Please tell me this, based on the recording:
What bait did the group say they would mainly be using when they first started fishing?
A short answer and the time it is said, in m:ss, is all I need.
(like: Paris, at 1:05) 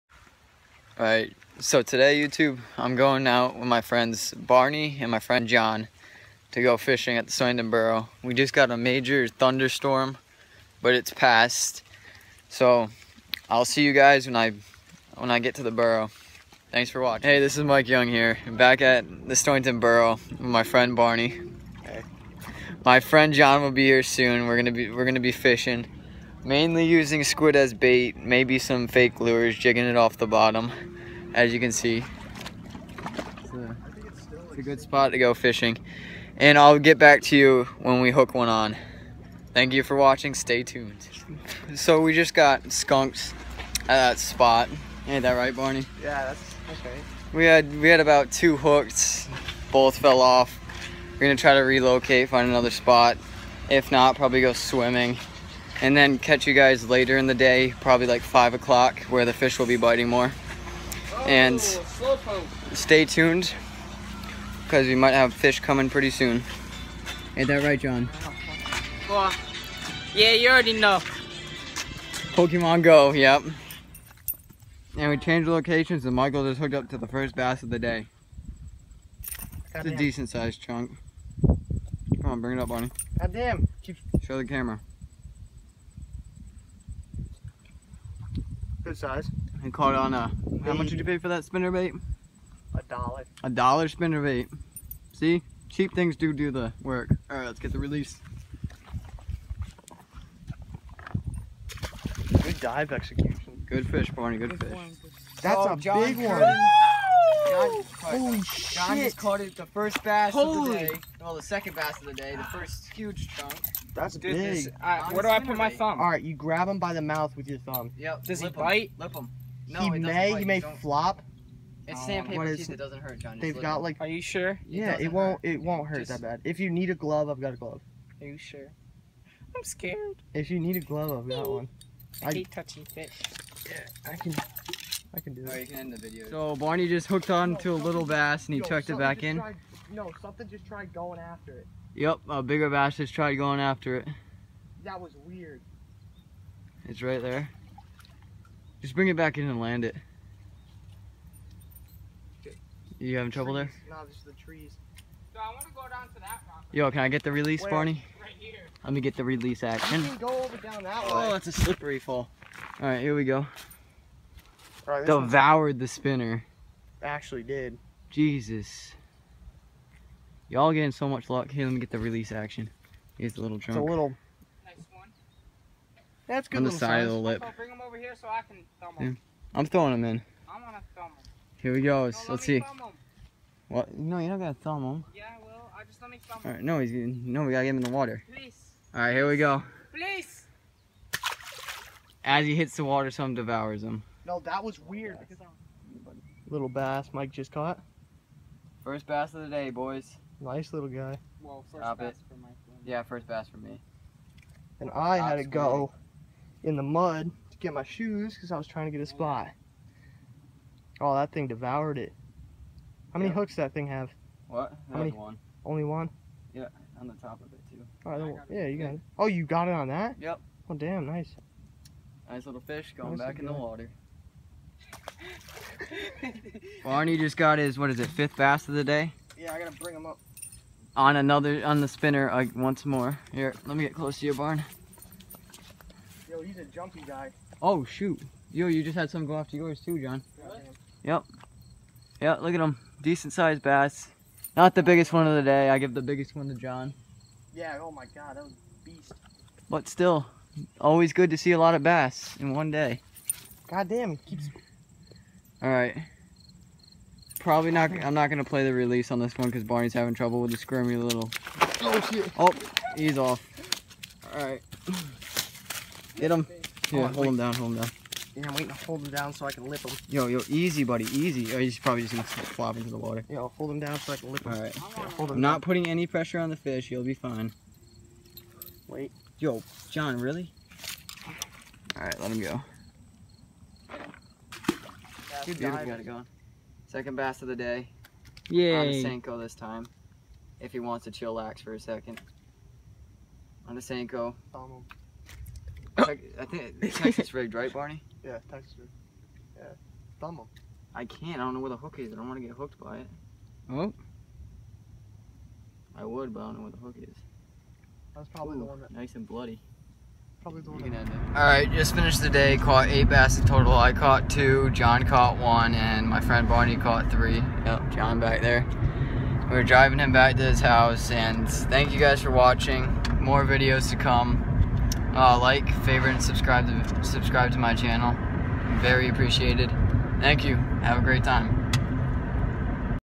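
squid, at 0:27.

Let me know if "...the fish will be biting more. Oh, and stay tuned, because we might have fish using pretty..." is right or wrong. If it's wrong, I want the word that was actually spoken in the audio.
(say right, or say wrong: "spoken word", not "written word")
wrong: "coming", not "using".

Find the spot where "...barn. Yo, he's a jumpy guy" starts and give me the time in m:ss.
3:54.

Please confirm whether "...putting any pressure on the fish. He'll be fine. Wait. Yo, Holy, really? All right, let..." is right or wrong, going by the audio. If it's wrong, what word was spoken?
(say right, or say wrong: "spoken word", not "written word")
wrong: "John", not "Holy".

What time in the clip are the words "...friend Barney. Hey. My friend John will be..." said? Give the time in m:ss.
0:20.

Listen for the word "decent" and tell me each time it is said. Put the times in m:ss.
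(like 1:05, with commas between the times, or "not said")
1:19, 4:03.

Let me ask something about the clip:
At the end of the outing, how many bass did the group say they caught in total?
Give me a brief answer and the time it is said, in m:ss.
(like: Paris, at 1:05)
8, at 5:12.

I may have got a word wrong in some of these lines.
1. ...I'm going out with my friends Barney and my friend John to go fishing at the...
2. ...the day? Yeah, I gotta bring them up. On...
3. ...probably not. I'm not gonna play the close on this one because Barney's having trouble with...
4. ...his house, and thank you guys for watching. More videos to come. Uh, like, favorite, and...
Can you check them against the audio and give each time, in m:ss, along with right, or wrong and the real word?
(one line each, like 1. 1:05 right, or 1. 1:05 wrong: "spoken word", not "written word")
1. 0:02 right
2. 3:48 right
3. 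4:17 wrong: "release", not "close"
4. 5:20 right.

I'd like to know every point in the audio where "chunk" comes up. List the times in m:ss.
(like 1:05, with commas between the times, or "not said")
1:20, 1:53.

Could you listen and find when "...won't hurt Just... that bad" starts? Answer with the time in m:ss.
2:05.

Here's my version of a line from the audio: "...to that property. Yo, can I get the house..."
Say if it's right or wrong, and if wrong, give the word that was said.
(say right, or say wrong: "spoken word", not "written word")
wrong: "release", not "house".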